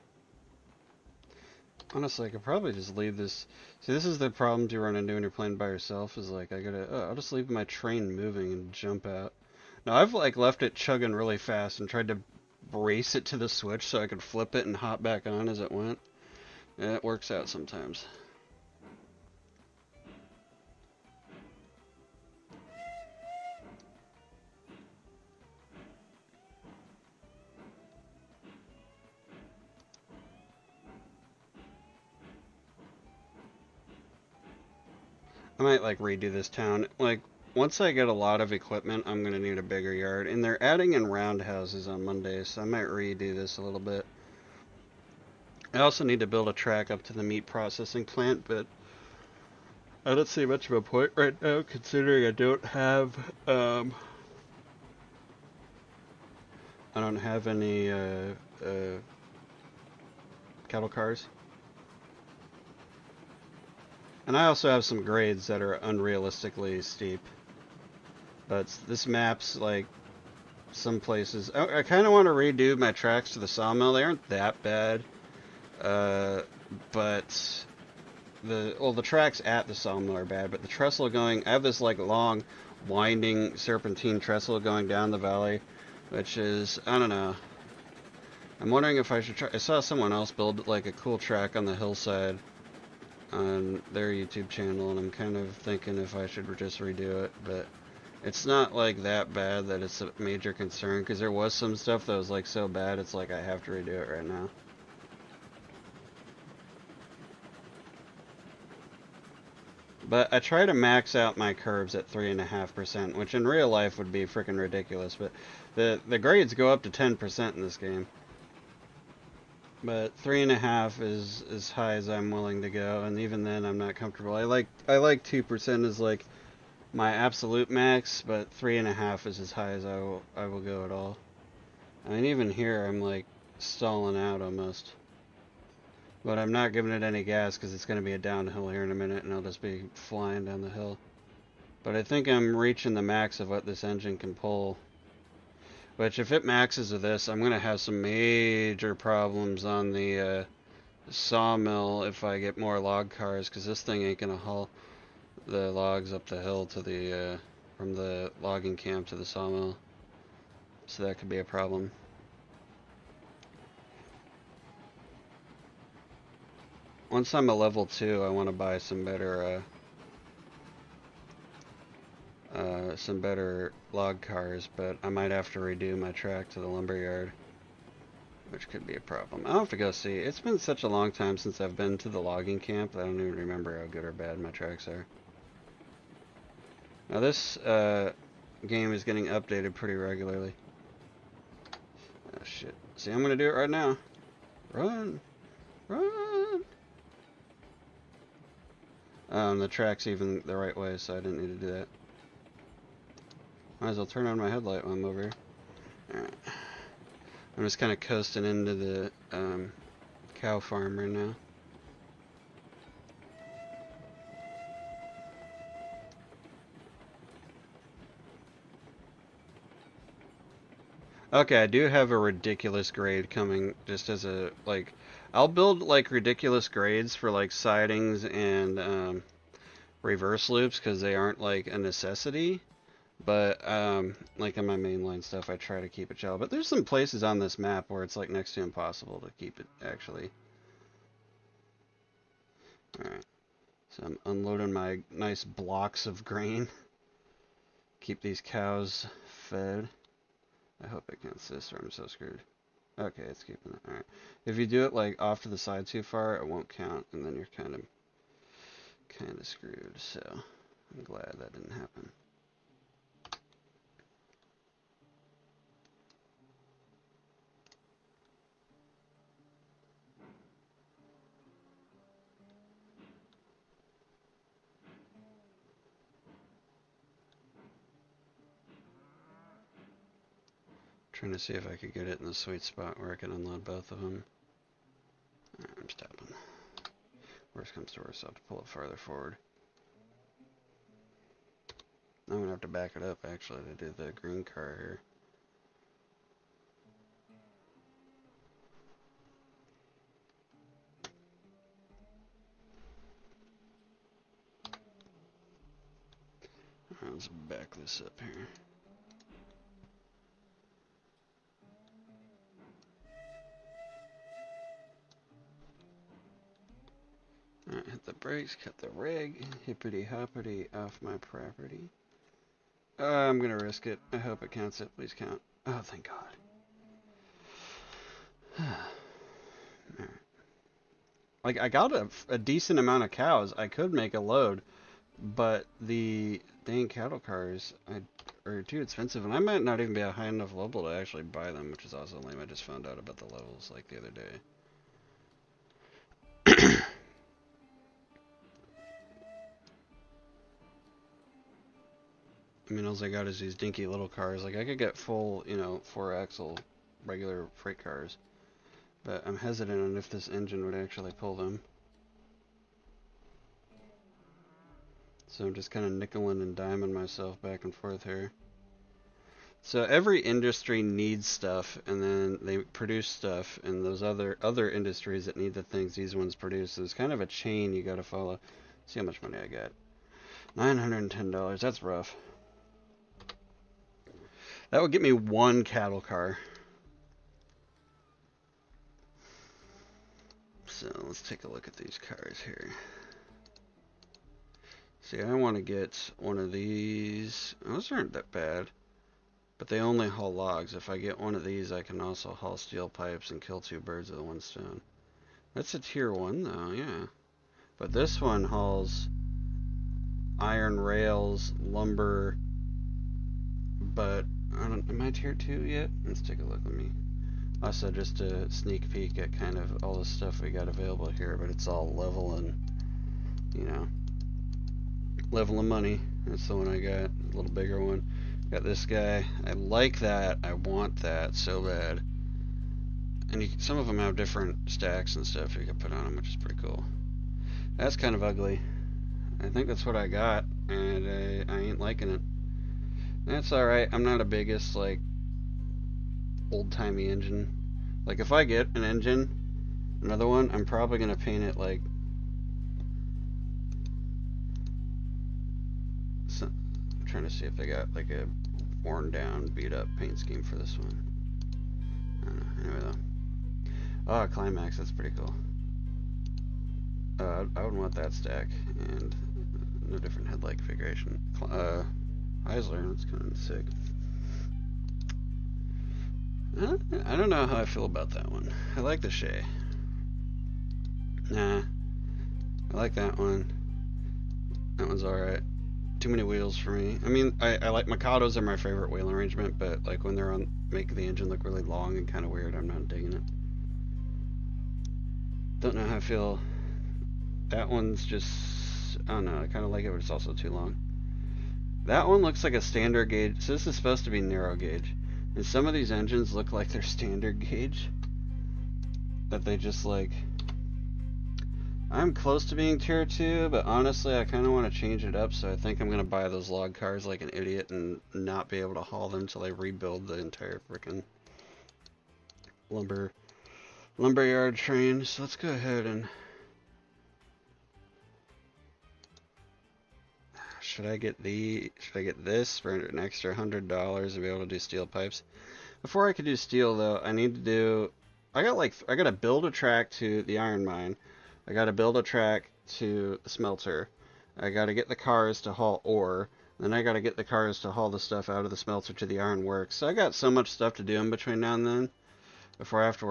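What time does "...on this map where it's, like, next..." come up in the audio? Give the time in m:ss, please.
3:57.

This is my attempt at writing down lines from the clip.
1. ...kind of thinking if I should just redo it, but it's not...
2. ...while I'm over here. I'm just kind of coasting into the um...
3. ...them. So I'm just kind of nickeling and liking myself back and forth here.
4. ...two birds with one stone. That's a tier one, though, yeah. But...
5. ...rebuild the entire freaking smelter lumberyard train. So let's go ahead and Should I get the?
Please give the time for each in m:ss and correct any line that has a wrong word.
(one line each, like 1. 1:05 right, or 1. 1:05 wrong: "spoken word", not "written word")
1. 1:35 right
2. 3:24 right
3. 6:01 wrong: "diming", not "liking"
4. 6:43 right
5. 8:39 wrong: "lumber", not "smelter".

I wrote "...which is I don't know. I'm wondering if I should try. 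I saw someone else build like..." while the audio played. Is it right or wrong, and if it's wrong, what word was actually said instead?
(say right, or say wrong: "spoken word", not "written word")
right.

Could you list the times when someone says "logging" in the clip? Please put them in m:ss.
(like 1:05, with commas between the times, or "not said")
2:38, 3:02.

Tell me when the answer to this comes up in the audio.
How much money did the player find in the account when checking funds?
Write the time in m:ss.
6:20.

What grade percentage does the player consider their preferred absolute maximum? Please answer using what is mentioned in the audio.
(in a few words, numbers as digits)
2%.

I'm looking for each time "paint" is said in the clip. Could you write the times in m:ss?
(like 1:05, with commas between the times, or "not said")
7:31, 7:39.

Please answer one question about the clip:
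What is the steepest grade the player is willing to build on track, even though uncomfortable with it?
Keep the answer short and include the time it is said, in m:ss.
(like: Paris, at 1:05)
3.5%, at 1:52.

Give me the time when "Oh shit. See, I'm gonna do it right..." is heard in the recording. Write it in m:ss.
3:12.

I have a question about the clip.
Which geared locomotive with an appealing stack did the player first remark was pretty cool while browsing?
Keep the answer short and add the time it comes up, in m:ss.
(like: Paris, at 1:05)
Climax, at 7:44.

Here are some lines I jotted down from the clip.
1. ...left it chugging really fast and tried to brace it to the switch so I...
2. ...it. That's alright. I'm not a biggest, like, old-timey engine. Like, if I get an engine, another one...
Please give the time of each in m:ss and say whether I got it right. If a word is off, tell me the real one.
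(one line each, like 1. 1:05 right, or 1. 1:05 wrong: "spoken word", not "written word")
1. 0:10 right
2. 7:22 right.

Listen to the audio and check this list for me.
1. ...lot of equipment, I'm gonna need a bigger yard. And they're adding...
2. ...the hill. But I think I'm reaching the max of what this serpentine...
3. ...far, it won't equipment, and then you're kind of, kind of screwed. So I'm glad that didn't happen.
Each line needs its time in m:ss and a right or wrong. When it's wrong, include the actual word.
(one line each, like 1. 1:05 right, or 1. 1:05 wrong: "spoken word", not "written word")
1. 0:38 right
2. 2:20 wrong: "engine", not "serpentine"
3. 4:16 wrong: "count", not "equipment".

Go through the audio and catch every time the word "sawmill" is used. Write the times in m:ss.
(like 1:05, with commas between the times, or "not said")
1:13, 1:19, 2:31, 2:39.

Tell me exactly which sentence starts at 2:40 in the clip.
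So that could be a problem.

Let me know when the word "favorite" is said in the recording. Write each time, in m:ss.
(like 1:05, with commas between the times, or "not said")
8:08.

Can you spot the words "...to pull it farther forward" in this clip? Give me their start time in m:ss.
4:48.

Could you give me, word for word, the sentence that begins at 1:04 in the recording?
And I also have some grades that are unrealistically steep.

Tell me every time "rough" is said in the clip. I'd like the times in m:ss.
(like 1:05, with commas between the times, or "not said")
6:21.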